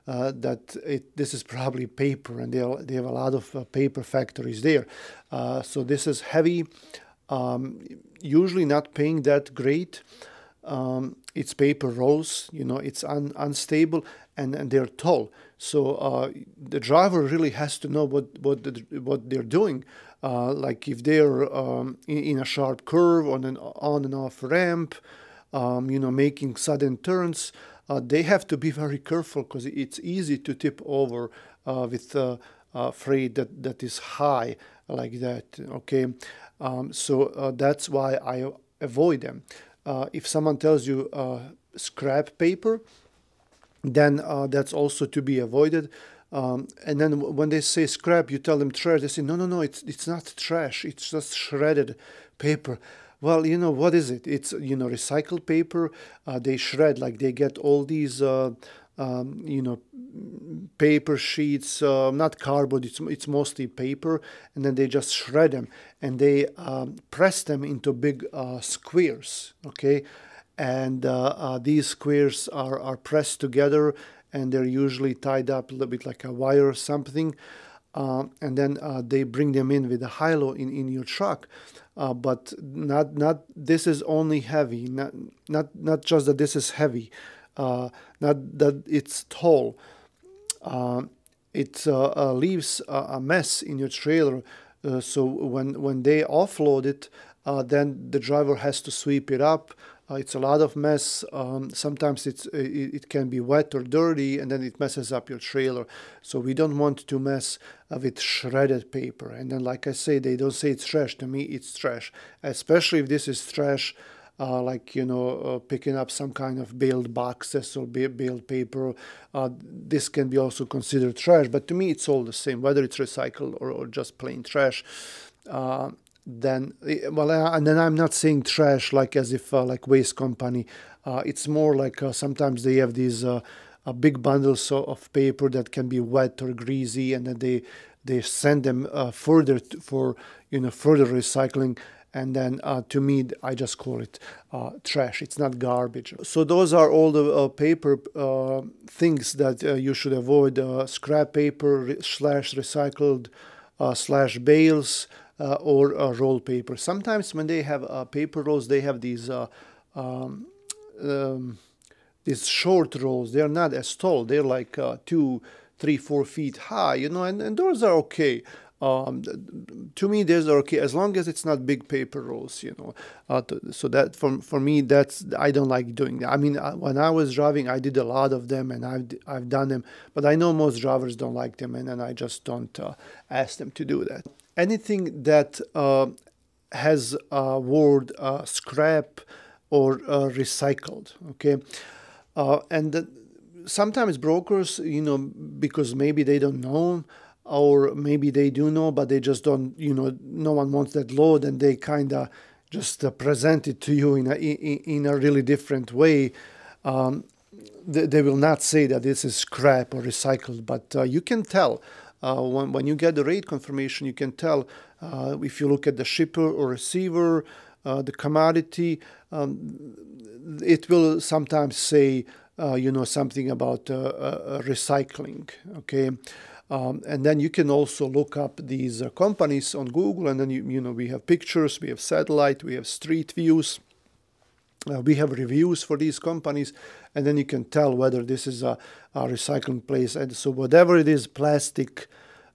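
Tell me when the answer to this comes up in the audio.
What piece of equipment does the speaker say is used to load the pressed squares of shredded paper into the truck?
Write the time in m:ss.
1:20.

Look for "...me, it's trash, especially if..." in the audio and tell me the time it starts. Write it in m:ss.
1:51.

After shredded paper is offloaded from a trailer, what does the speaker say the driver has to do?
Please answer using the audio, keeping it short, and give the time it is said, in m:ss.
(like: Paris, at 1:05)
sweep it up, at 1:38.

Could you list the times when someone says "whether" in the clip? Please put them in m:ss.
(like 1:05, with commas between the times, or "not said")
2:02, 3:57.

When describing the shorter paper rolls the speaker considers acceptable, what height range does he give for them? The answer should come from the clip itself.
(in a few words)
2 to 4 feet.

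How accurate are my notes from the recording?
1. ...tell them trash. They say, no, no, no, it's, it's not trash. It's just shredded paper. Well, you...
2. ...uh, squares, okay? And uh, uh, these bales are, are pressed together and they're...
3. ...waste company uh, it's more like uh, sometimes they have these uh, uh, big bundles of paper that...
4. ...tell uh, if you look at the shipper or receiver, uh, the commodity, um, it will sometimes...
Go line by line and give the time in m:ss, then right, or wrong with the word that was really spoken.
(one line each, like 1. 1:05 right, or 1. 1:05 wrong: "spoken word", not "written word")
1. 0:48 right
2. 1:08 wrong: "squares", not "bales"
3. 2:09 right
4. 3:34 right.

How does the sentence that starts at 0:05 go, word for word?
Uh, so this is heavy, um, usually not paying that great.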